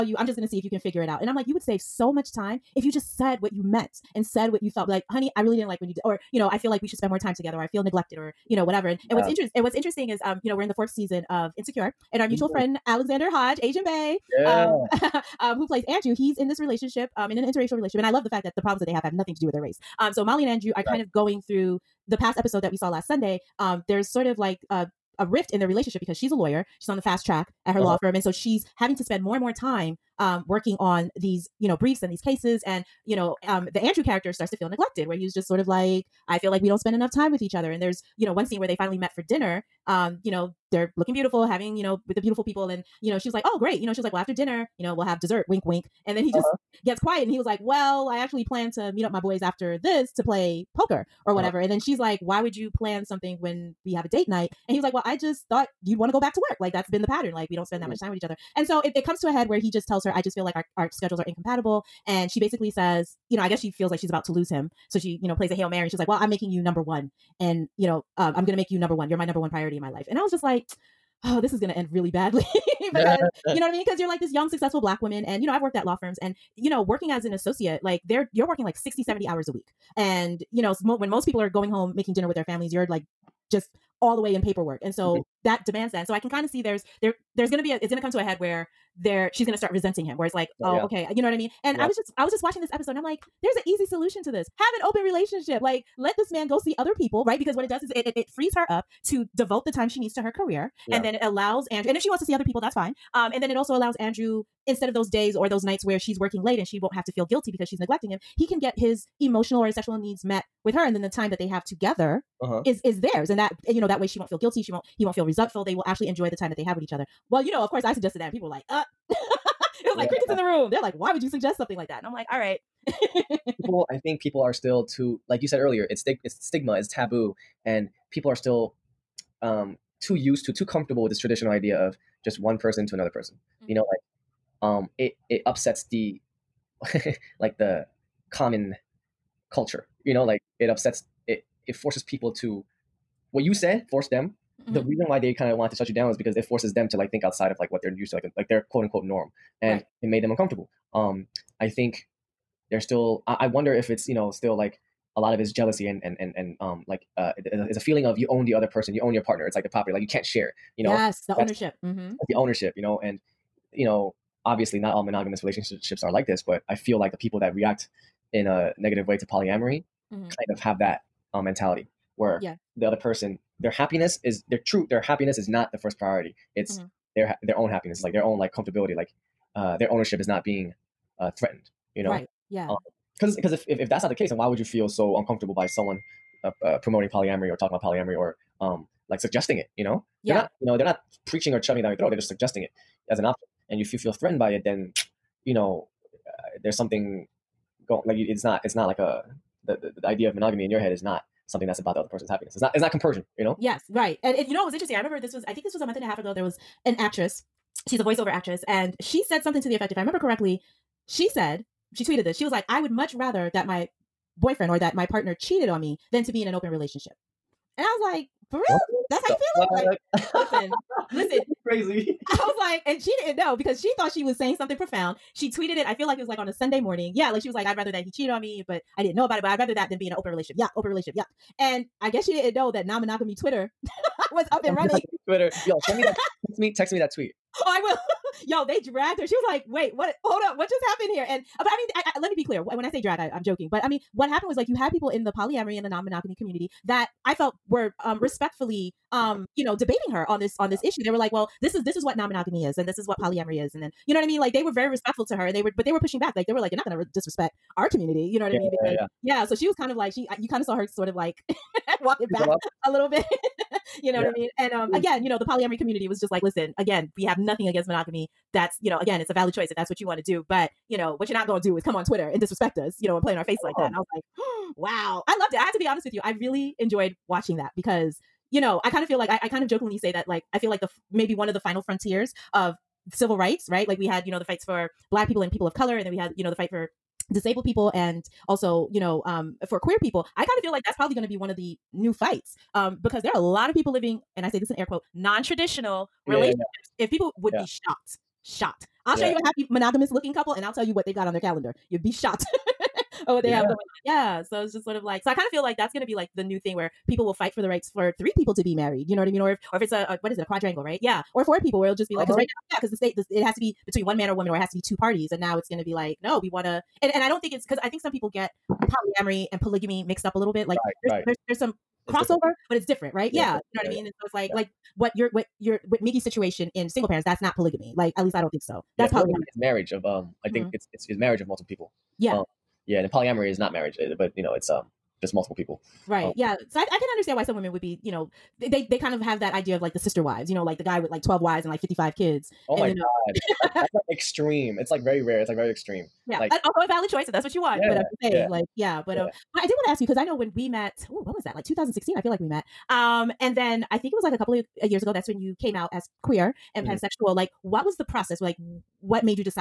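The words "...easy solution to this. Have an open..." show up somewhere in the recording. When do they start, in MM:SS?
01:33.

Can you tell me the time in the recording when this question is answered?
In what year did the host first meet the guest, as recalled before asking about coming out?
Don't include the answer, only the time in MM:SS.
05:51.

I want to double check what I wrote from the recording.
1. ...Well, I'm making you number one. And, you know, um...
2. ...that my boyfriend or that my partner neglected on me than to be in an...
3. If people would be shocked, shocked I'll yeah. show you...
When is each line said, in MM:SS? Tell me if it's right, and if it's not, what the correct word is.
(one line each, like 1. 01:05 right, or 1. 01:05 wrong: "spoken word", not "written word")
1. 01:06 right
2. 03:33 wrong: "cheated", not "neglected"
3. 04:57 right.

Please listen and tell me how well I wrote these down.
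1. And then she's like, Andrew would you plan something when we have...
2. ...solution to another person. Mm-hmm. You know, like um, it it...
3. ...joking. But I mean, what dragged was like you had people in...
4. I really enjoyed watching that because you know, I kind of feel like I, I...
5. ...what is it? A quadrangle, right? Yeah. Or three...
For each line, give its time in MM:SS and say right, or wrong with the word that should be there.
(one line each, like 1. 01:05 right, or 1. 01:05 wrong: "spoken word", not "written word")
1. 00:51 wrong: "Why", not "Andrew"
2. 02:12 wrong: "person", not "solution"
3. 04:03 wrong: "happened", not "dragged"
4. 04:36 right
5. 05:10 wrong: "four", not "three".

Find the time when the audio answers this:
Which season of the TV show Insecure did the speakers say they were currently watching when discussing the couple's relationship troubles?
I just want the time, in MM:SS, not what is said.
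00:10.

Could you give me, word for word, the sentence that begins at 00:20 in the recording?
kind of going through the past episode that we saw last Sunday.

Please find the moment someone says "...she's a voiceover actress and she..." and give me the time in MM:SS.
03:27.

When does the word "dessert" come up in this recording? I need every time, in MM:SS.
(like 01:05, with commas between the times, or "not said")
00:45.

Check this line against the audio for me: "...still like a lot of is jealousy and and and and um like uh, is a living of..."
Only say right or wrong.
wrong.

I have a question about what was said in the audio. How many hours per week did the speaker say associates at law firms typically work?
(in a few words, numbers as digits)
60 to 70.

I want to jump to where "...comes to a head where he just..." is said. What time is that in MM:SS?
00:59.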